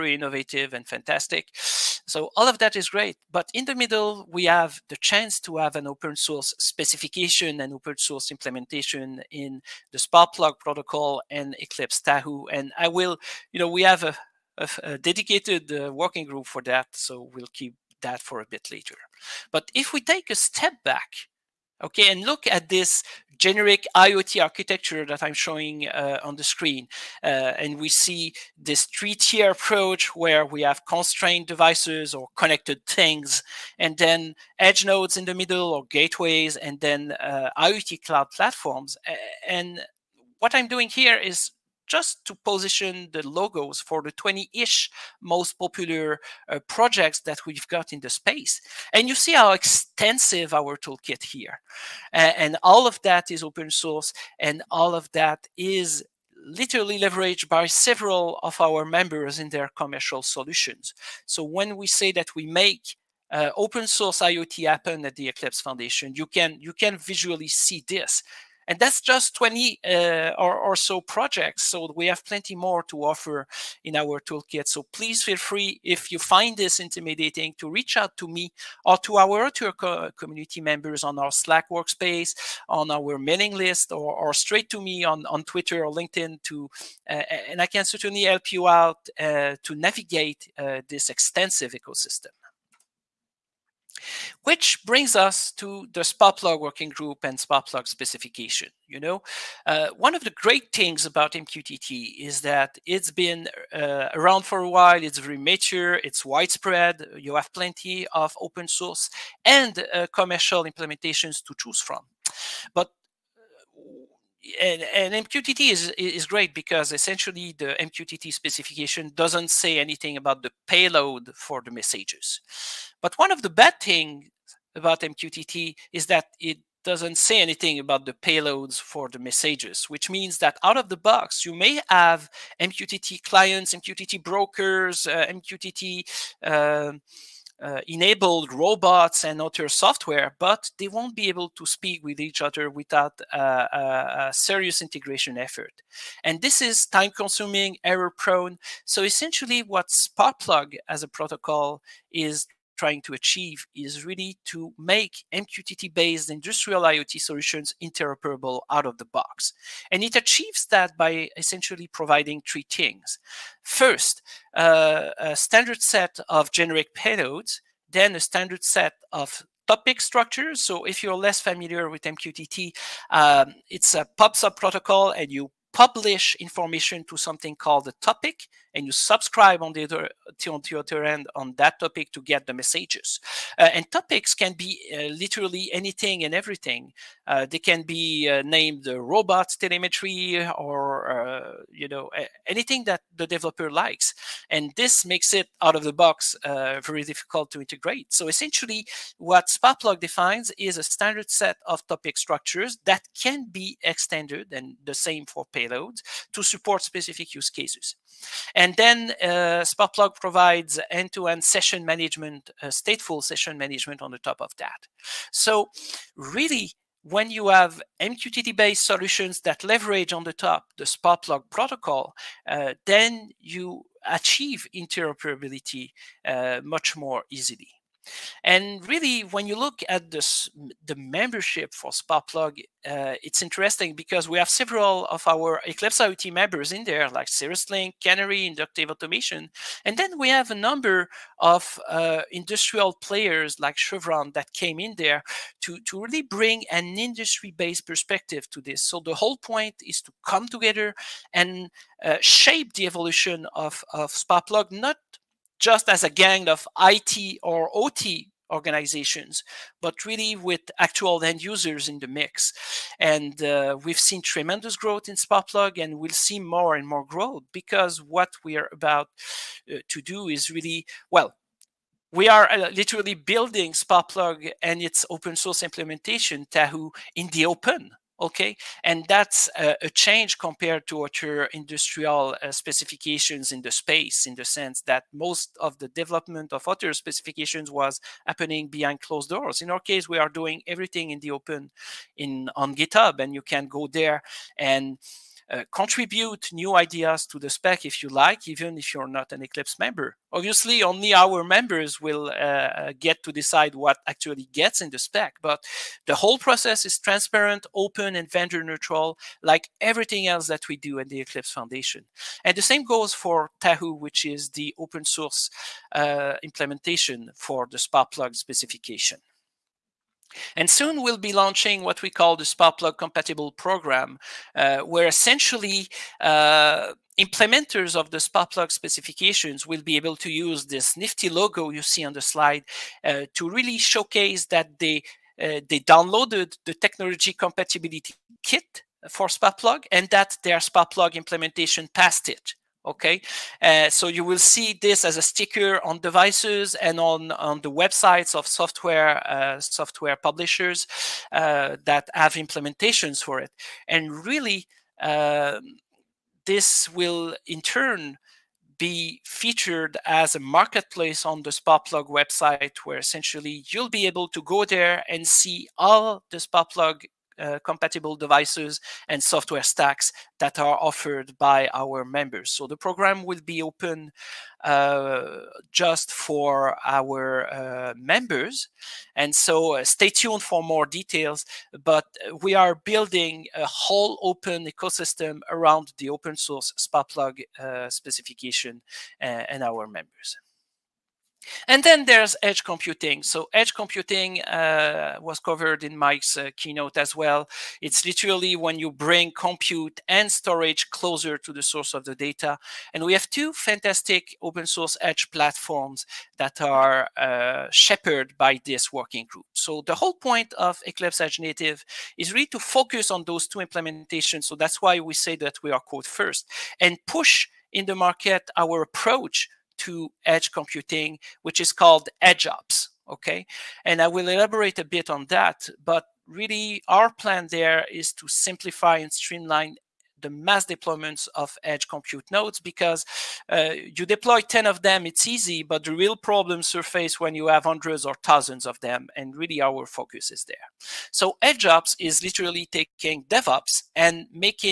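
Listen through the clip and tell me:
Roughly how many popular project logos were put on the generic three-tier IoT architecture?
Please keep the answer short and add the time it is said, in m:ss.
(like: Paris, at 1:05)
20, at 0:44.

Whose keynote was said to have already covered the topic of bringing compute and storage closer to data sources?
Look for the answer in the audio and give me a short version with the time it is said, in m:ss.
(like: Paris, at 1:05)
Mike, at 6:35.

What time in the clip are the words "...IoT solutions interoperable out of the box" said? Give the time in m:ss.
2:36.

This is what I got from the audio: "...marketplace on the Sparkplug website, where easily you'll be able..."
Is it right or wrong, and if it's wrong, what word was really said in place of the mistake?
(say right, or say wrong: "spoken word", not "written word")
wrong: "essentially", not "easily".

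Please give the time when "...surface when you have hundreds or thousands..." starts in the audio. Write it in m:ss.
7:16.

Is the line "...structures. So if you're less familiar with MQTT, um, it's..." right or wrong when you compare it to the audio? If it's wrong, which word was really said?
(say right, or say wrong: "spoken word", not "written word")
right.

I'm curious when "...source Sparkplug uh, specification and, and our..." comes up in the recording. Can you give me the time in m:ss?
6:26.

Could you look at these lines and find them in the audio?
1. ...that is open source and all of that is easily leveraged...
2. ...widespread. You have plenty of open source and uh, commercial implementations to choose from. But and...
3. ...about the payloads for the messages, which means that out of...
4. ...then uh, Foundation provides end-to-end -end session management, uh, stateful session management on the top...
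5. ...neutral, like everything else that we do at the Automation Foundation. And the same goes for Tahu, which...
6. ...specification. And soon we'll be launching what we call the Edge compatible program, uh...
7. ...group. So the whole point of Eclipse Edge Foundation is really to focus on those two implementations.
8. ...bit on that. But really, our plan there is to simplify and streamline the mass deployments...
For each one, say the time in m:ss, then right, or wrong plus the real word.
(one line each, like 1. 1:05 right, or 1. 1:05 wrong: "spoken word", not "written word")
1. 0:53 wrong: "literally", not "easily"
2. 1:46 right
3. 2:07 right
4. 3:28 wrong: "Sparkplug", not "Foundation"
5. 5:08 wrong: "Eclipse", not "Automation"
6. 5:18 wrong: "Sparkplug", not "Edge"
7. 6:49 wrong: "Native", not "Foundation"
8. 7:04 right.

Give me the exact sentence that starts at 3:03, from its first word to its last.
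Uh, and topics can be uh, literally anything and everything.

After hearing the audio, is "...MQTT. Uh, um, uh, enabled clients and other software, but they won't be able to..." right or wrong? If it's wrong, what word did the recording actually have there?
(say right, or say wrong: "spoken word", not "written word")
wrong: "robots", not "clients".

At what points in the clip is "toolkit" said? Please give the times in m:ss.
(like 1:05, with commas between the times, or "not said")
0:50, 1:14.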